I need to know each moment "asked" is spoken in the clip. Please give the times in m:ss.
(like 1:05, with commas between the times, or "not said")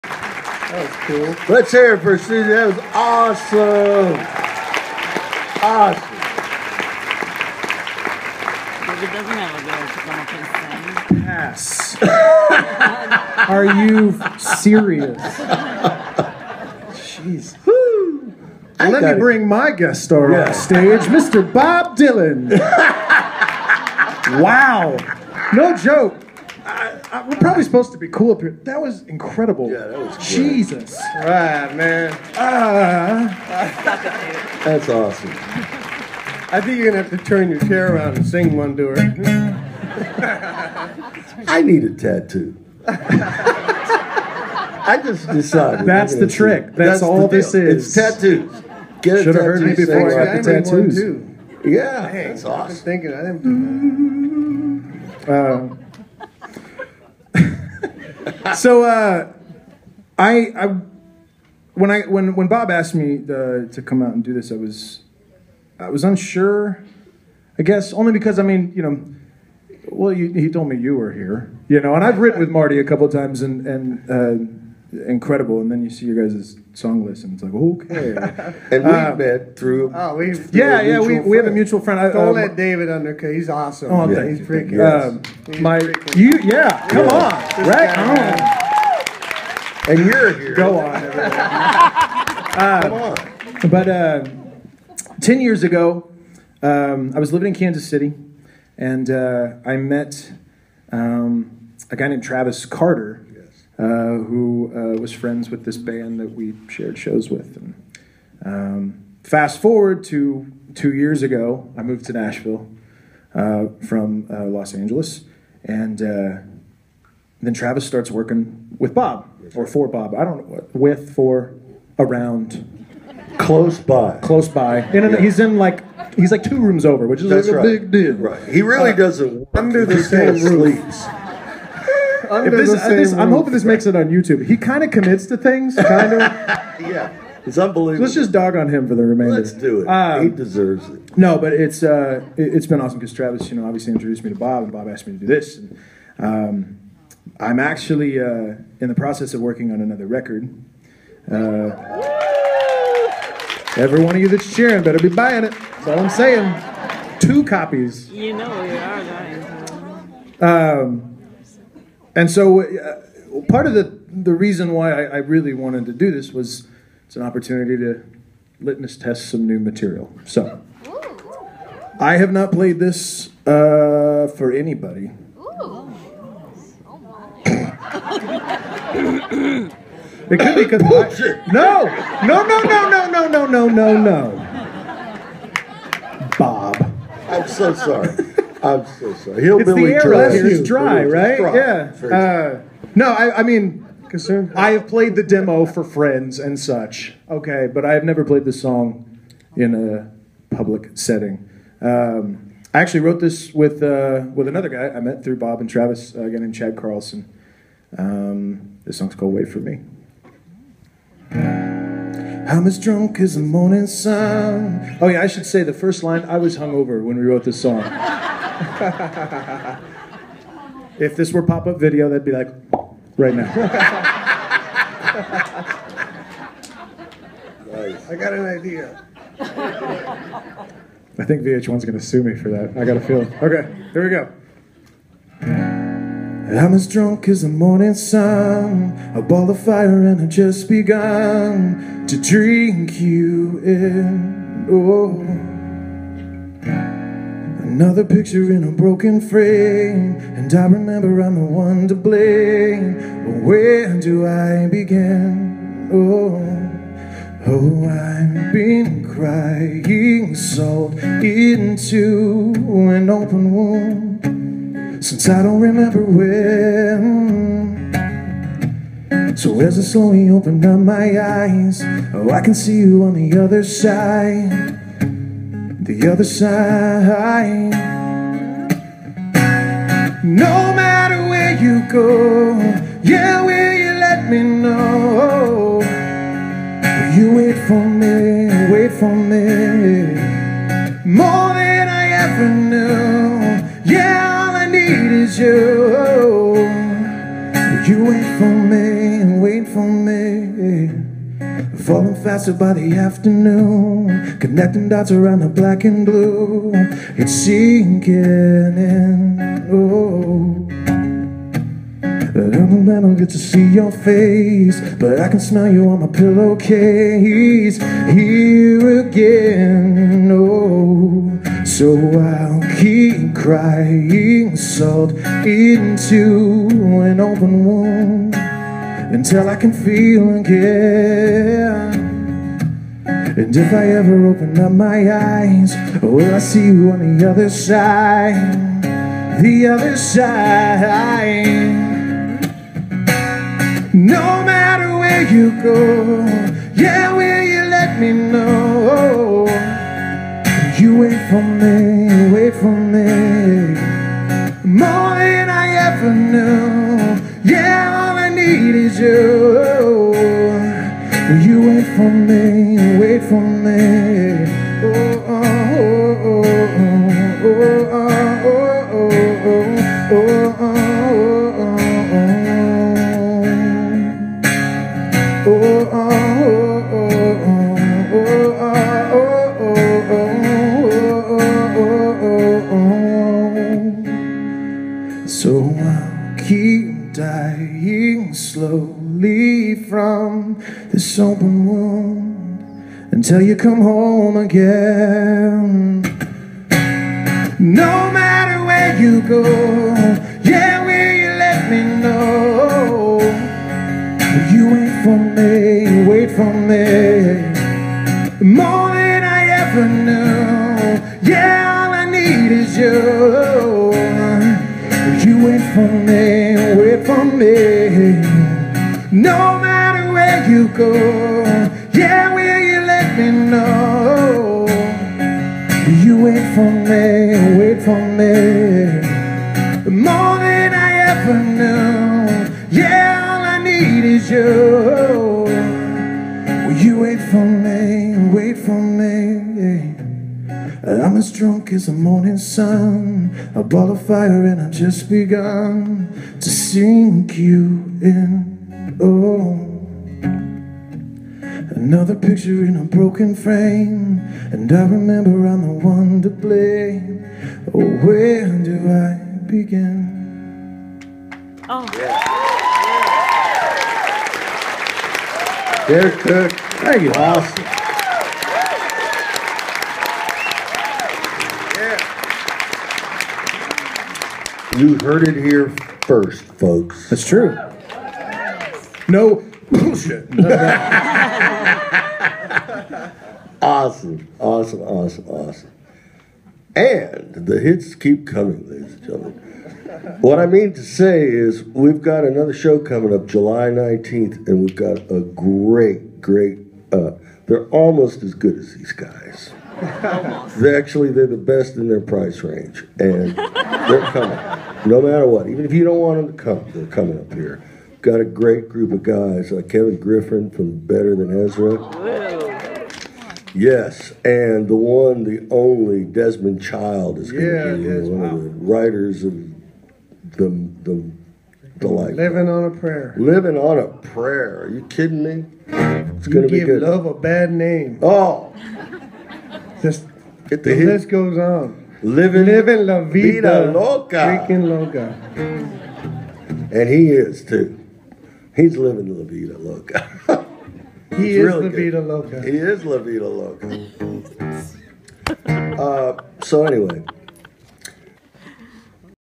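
1:02, 2:24.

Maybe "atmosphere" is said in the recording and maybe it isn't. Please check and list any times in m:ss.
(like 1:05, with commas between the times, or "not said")
not said.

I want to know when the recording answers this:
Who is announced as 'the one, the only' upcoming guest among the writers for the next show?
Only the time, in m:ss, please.
8:36.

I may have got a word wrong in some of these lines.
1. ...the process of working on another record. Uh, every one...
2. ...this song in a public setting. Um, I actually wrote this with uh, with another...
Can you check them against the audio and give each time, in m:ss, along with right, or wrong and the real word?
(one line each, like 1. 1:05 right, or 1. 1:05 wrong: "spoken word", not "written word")
1. 2:28 right
2. 3:18 right.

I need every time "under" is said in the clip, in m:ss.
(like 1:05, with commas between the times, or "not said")
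1:22, 2:09.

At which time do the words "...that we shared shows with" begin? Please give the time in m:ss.
1:46.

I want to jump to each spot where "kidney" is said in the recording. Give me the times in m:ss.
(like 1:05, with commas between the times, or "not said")
not said.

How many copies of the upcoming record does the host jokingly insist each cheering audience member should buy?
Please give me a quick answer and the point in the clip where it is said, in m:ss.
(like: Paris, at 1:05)
2, at 2:37.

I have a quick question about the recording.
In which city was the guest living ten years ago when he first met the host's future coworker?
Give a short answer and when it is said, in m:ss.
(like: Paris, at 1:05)
Kansas City, at 1:37.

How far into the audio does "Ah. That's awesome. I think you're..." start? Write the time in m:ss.
0:32.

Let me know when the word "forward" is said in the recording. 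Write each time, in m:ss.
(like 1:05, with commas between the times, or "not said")
1:49.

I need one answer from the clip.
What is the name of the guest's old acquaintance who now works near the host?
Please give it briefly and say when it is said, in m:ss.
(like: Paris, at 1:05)
Travis Carter, at 1:42.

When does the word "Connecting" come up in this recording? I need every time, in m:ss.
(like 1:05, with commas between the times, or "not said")
5:04.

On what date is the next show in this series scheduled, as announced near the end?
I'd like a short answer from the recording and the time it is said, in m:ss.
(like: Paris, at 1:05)
July 19th, at 8:13.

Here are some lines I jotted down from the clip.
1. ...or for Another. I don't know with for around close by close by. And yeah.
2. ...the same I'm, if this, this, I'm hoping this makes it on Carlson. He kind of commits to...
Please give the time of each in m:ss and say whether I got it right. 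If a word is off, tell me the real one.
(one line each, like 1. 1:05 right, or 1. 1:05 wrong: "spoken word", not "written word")
1. 1:59 wrong: "Bob", not "Another"
2. 2:09 wrong: "YouTube", not "Carlson".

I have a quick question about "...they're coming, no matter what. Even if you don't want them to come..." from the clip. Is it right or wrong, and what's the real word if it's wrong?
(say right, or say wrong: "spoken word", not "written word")
right.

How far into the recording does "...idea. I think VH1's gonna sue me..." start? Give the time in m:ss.
3:48.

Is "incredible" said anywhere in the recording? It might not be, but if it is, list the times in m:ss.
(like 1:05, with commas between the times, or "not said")
0:29, 1:14.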